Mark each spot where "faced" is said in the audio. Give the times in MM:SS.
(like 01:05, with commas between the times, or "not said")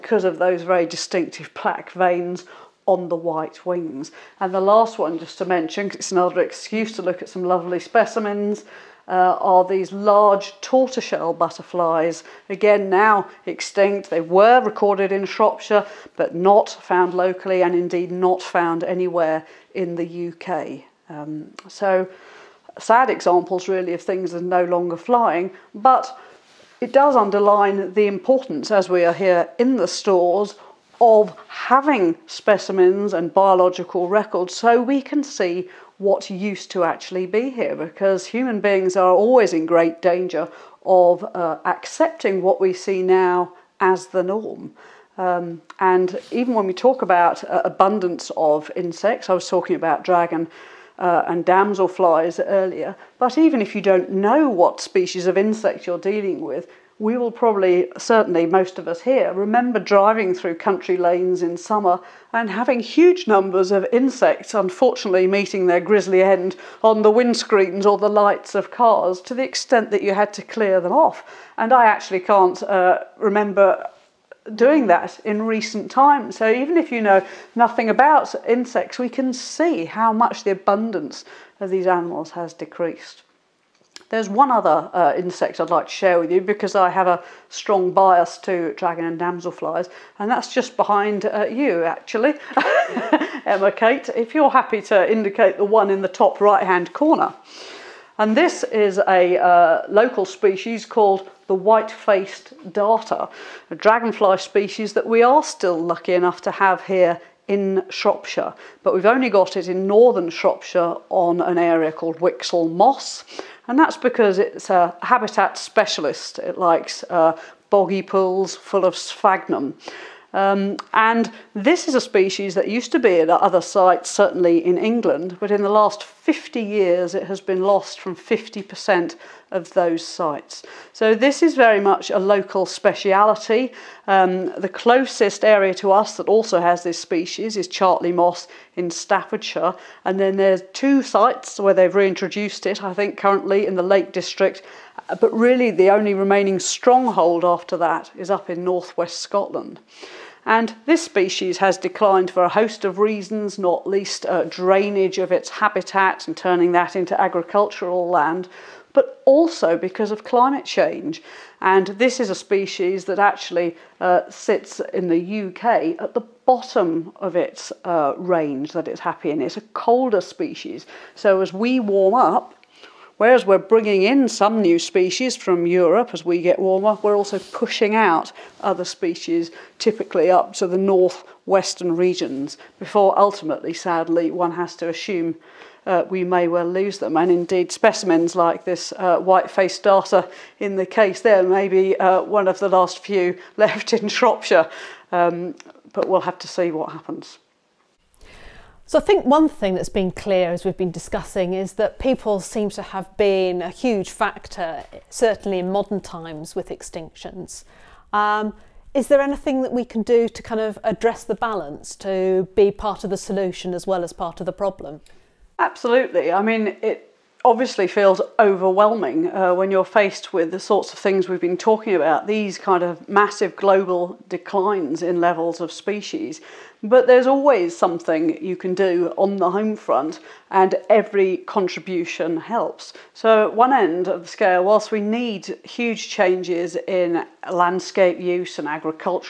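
01:41, 03:09, 03:39.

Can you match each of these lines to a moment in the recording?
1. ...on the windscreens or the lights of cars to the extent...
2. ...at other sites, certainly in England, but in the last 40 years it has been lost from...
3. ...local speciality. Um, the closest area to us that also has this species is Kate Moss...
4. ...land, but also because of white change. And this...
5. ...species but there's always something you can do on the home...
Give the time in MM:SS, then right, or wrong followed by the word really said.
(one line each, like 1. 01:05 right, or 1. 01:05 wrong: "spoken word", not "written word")
1. 01:06 right
2. 02:03 wrong: "50", not "40"
3. 02:12 wrong: "Chartley", not "Kate"
4. 02:38 wrong: "climate", not "white"
5. 03:45 right.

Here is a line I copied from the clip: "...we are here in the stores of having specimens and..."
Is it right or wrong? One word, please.
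right.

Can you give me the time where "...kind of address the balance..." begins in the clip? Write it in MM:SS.
03:30.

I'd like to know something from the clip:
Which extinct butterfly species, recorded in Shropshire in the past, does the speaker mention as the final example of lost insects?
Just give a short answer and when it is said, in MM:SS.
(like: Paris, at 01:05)
Large tortoiseshell, at 00:09.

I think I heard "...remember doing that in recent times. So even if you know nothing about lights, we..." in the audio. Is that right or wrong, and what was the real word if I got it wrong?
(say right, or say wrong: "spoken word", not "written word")
wrong: "insects", not "lights".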